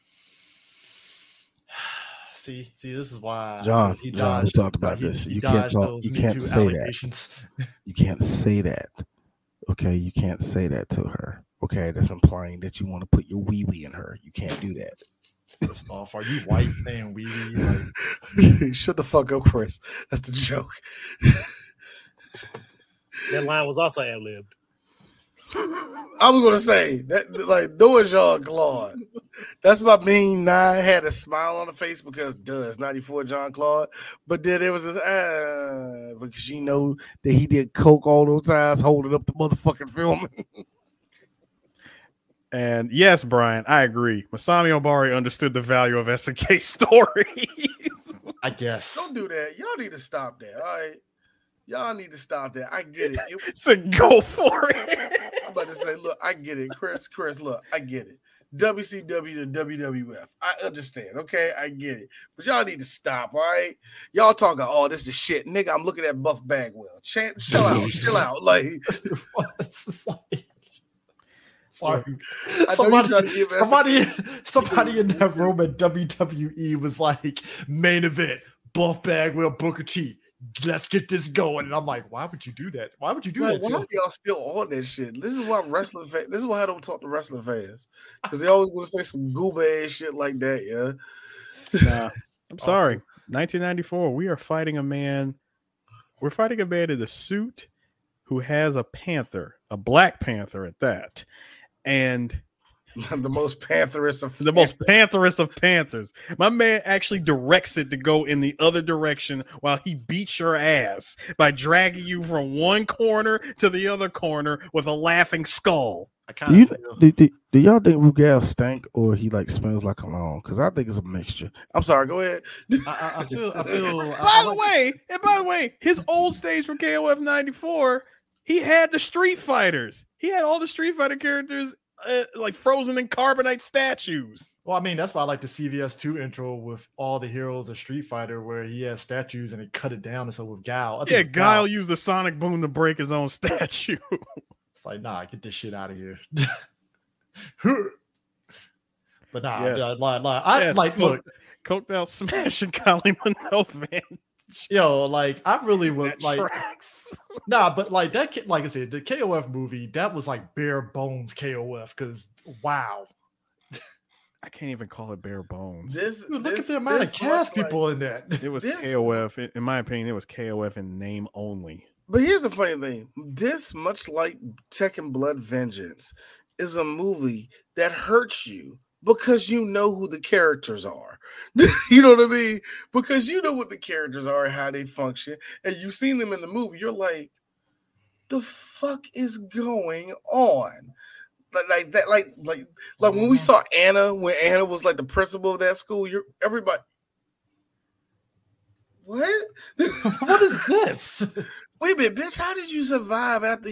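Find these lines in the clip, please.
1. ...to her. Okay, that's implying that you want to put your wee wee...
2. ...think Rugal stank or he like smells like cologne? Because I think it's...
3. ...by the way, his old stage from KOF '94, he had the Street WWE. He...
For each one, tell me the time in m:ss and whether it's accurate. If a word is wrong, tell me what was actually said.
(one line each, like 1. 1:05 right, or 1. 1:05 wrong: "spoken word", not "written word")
1. 0:10 right
2. 1:57 right
3. 2:05 wrong: "Fighters", not "WWE".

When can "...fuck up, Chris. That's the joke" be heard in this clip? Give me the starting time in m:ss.
0:19.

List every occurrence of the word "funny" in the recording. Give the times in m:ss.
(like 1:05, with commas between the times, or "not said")
2:52.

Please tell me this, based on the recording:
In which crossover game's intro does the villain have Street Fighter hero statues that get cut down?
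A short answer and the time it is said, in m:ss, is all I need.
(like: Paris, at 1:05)
CVS 2, at 2:15.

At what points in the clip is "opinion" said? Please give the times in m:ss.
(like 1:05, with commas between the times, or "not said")
2:49.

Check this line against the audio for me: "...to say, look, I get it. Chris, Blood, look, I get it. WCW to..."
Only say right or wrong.
wrong.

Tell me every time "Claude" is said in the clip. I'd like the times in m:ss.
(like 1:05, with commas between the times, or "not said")
0:28, 0:33.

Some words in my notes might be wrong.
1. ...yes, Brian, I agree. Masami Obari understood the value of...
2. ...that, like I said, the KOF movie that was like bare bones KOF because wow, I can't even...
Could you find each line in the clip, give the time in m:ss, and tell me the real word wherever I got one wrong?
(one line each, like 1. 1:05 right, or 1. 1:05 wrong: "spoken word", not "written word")
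1. 0:42 right
2. 2:38 right.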